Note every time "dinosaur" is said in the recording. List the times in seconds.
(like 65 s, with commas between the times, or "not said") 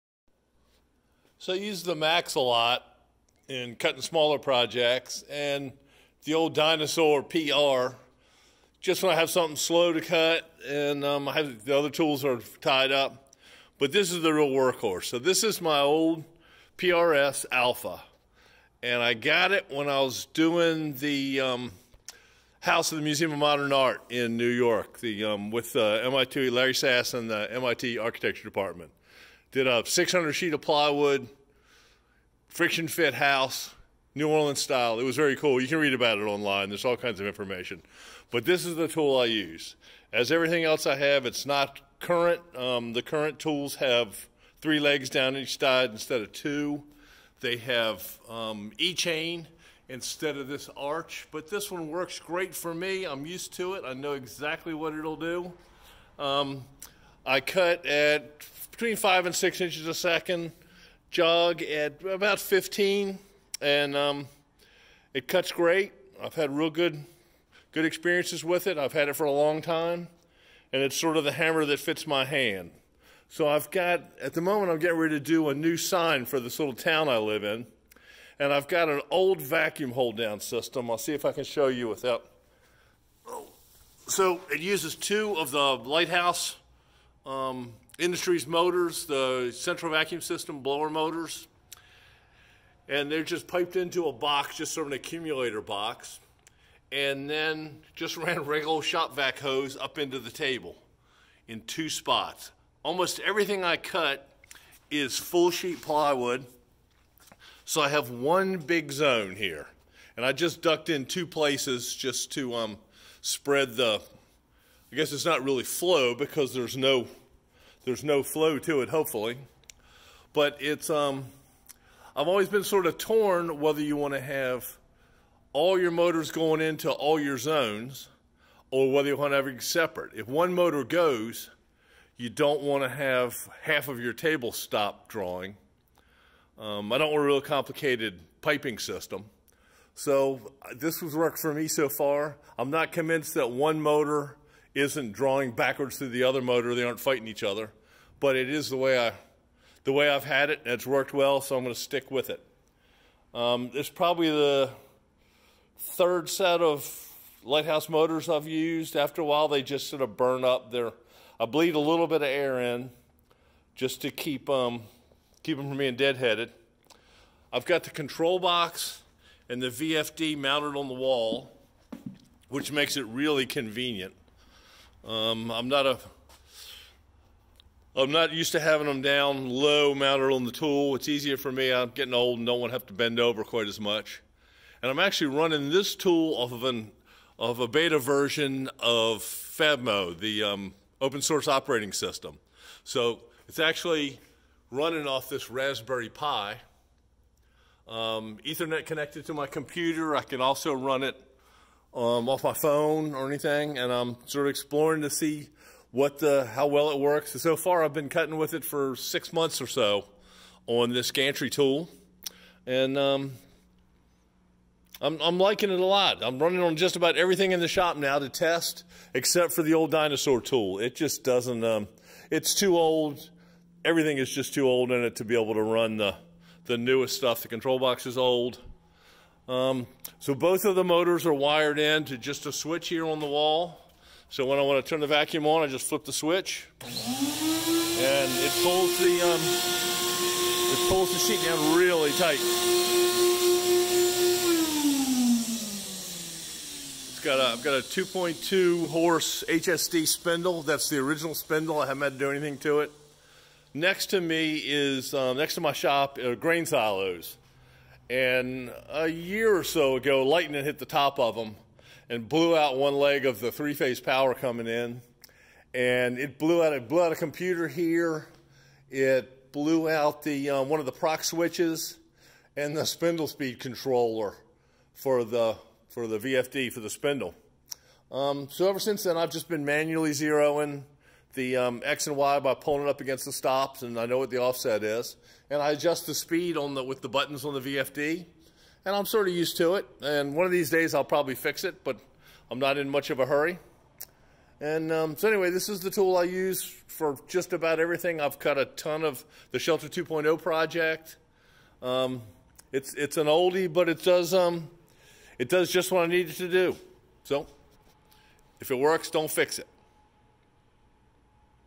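6 s, 219 s.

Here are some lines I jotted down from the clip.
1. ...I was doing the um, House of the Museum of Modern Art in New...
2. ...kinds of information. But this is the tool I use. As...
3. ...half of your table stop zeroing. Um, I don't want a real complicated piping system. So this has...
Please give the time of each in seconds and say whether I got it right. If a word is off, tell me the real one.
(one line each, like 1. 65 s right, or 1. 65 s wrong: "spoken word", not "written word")
1. 19 s right
2. 36 s right
3. 133 s wrong: "drawing", not "zeroing".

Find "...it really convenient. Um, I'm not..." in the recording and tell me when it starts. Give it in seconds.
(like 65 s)
172 s.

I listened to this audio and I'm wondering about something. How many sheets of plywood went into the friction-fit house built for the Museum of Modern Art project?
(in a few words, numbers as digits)
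600.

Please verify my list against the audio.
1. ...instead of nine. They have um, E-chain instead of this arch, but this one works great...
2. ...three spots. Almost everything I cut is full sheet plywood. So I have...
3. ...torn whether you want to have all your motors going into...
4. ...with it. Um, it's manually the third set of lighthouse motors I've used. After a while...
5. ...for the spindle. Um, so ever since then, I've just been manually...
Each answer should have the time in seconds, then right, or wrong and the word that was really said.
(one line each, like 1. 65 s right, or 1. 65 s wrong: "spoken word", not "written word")
1. 45 s wrong: "two", not "nine"
2. 101 s wrong: "two", not "three"
3. 122 s right
4. 152 s wrong: "probably", not "manually"
5. 276 s right.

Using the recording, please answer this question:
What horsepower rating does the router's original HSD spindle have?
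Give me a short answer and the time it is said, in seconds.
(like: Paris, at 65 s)
2.2, at 247 s.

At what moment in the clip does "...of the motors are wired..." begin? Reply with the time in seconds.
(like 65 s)
230 s.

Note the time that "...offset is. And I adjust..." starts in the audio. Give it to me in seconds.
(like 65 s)
284 s.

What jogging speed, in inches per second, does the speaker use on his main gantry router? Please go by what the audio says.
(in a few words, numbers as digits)
15.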